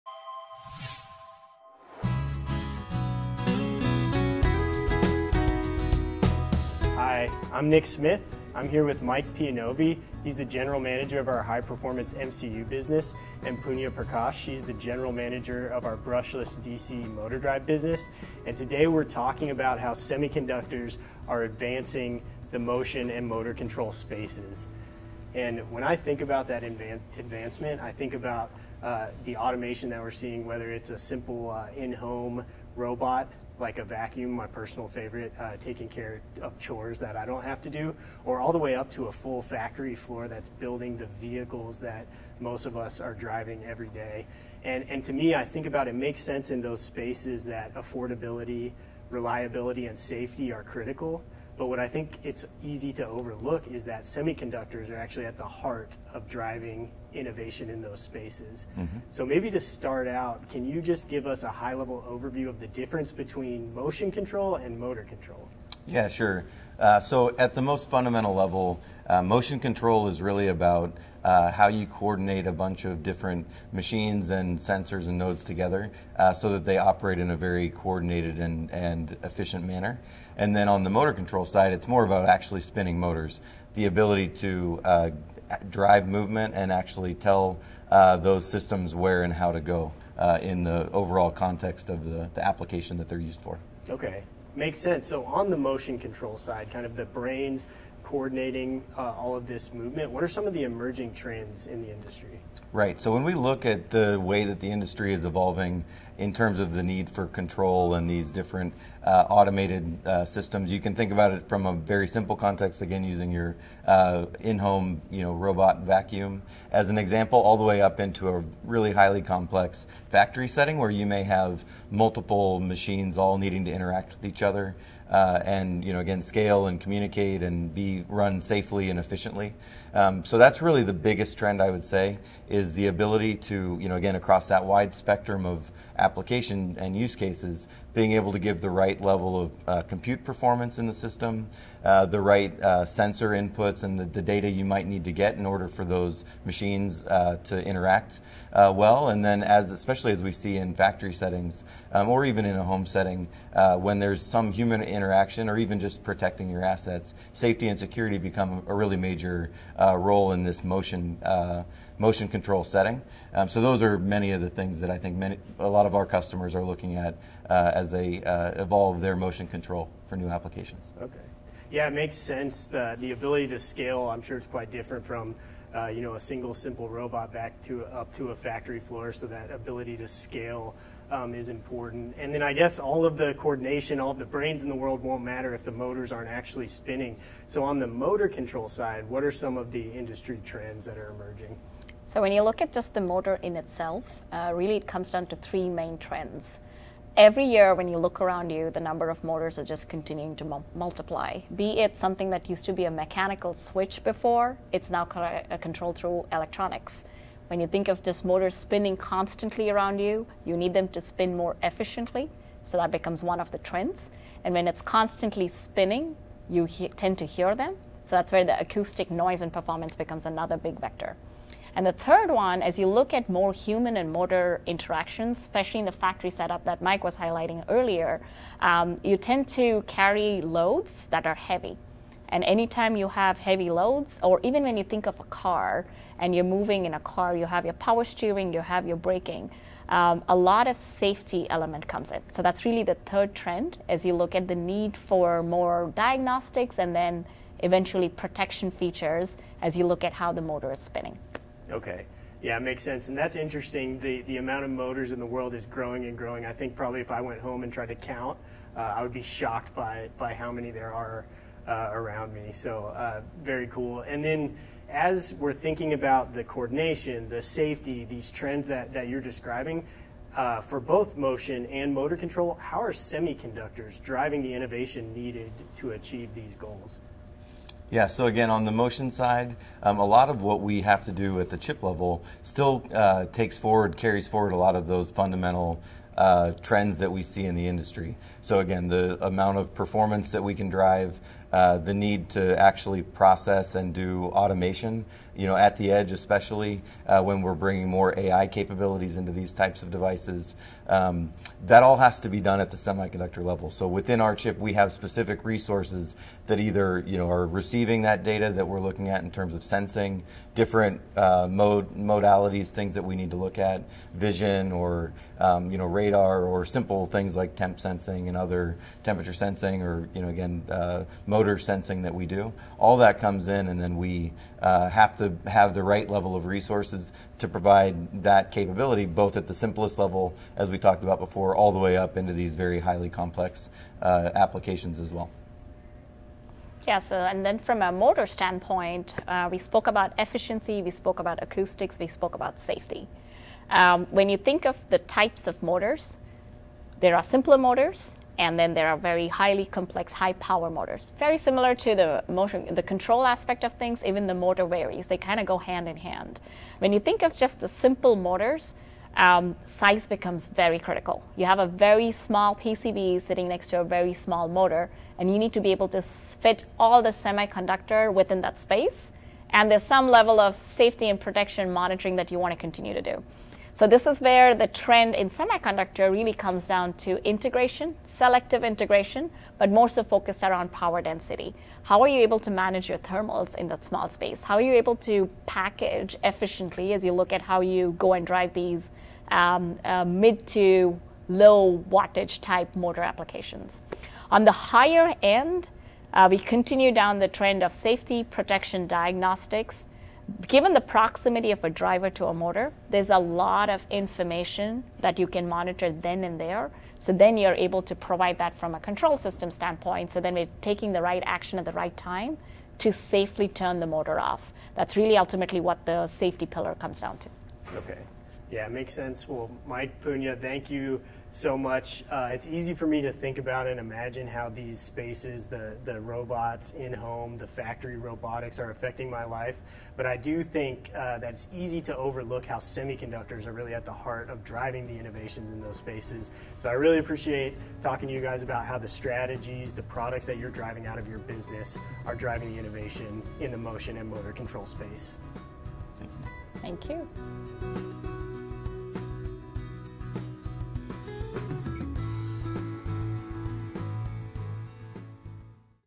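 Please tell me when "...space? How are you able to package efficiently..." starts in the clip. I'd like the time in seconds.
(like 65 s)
384 s.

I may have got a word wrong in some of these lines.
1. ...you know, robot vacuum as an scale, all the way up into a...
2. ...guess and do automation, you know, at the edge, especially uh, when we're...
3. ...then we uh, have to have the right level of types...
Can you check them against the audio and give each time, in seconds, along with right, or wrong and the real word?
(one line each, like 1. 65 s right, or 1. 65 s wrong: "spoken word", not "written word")
1. 115 s wrong: "example", not "scale"
2. 293 s wrong: "process", not "guess"
3. 323 s wrong: "resources", not "types".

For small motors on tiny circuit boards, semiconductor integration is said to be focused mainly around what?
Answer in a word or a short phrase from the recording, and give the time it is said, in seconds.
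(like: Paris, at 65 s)
power density, at 380 s.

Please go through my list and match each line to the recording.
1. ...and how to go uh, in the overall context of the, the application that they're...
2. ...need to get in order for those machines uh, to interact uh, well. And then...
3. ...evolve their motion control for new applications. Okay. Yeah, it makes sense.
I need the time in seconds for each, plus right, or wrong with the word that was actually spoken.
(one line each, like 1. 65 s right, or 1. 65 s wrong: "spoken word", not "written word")
1. 89 s right
2. 144 s right
3. 168 s right.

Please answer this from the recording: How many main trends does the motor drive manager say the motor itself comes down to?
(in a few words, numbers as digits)
3.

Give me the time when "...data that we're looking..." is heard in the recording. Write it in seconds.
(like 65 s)
308 s.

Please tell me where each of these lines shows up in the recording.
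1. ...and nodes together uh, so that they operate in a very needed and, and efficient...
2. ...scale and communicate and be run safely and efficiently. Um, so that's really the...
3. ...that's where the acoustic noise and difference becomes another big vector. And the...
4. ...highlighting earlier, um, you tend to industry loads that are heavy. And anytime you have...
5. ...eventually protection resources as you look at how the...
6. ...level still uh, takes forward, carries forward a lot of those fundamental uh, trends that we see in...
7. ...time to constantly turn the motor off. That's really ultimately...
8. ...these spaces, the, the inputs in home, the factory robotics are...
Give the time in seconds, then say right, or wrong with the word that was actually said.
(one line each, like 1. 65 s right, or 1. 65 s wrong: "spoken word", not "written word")
1. 75 s wrong: "coordinated", not "needed"
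2. 126 s right
3. 218 s wrong: "performance", not "difference"
4. 227 s wrong: "carry", not "industry"
5. 247 s wrong: "features", not "resources"
6. 281 s right
7. 411 s wrong: "safely", not "constantly"
8. 424 s wrong: "robots", not "inputs".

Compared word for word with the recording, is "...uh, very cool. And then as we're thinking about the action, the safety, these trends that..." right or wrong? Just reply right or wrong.
wrong.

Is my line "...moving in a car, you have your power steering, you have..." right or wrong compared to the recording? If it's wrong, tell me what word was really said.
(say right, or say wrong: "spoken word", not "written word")
right.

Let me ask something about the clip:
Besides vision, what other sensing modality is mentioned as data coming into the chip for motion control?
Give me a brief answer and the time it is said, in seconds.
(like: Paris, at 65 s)
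radar, at 315 s.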